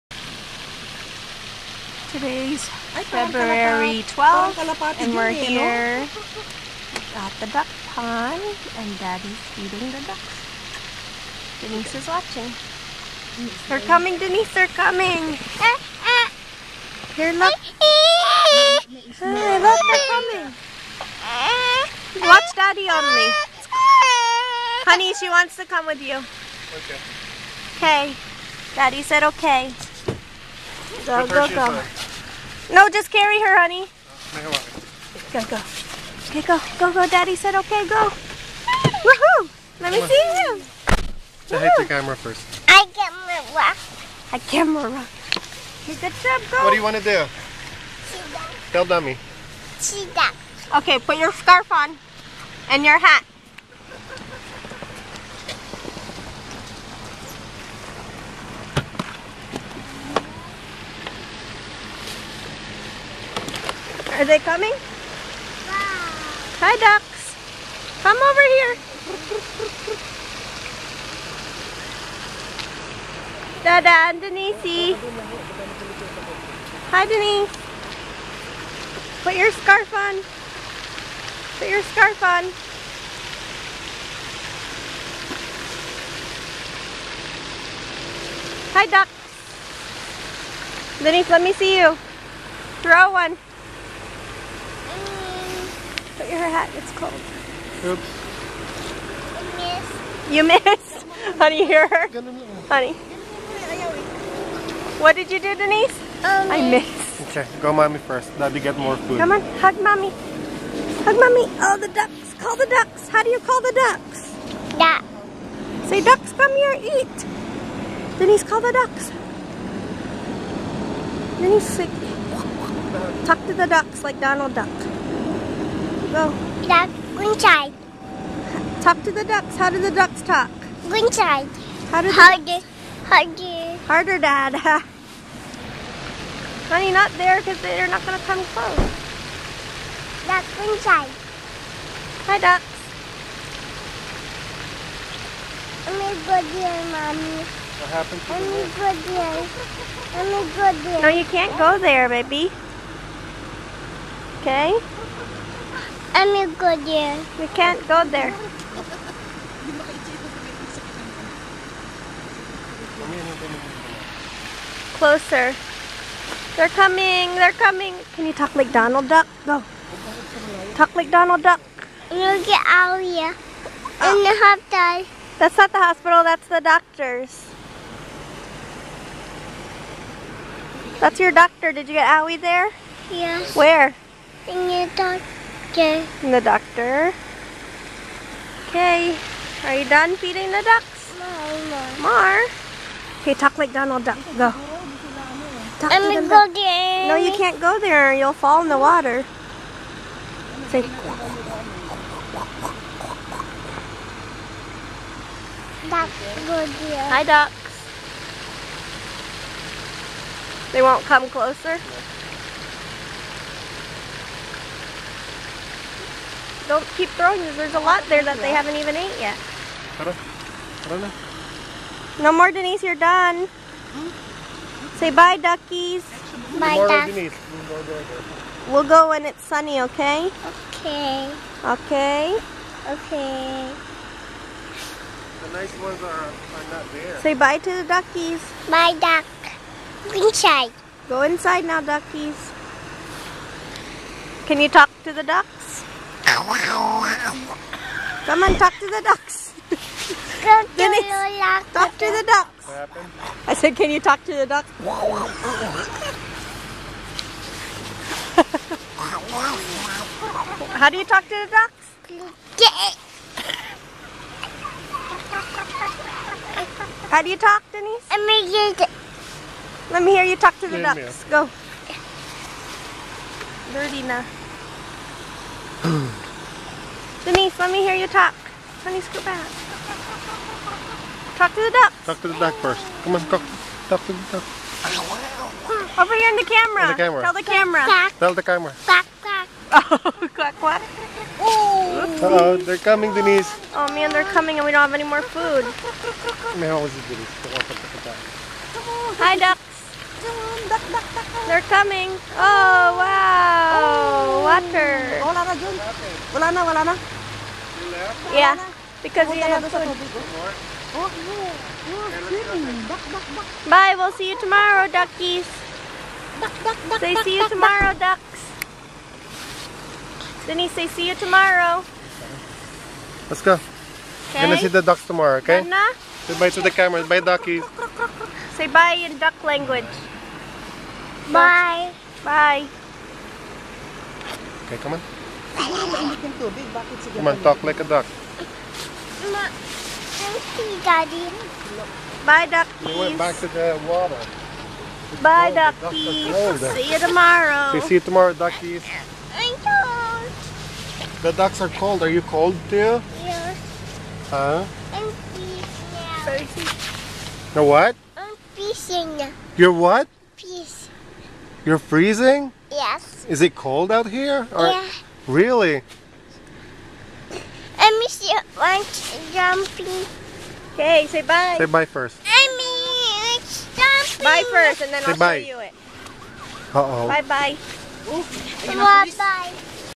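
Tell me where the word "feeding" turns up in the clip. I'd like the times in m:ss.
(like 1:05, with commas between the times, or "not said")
0:09, 3:10.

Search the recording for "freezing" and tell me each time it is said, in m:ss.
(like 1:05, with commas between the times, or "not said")
5:55, 6:01.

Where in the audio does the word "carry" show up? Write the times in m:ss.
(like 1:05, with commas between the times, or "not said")
0:33.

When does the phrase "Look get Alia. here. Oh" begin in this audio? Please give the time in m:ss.
2:52.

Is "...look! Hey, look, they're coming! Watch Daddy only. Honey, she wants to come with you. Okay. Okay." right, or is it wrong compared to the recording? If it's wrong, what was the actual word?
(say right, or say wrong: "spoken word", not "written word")
right.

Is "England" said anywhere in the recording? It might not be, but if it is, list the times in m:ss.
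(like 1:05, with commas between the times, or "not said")
not said.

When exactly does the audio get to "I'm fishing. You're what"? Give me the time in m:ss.
5:58.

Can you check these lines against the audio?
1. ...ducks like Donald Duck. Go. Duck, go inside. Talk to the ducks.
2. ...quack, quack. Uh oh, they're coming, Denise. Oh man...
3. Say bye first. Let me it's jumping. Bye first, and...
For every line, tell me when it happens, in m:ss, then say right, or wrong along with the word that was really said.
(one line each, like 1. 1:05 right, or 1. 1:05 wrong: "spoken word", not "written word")
1. 2:03 right
2. 4:50 right
3. 6:11 right.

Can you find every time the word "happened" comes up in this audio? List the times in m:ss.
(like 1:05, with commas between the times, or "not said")
2:27, 4:12.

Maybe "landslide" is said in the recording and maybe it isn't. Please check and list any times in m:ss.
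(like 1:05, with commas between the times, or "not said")
not said.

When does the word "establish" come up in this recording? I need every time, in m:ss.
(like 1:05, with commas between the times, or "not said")
not said.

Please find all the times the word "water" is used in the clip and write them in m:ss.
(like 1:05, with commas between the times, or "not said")
3:18, 5:04, 5:43.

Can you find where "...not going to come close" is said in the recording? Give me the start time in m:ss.
2:17.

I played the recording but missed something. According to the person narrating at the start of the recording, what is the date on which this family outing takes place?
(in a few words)
February 12th.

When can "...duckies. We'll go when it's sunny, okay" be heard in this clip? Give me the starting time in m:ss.
3:46.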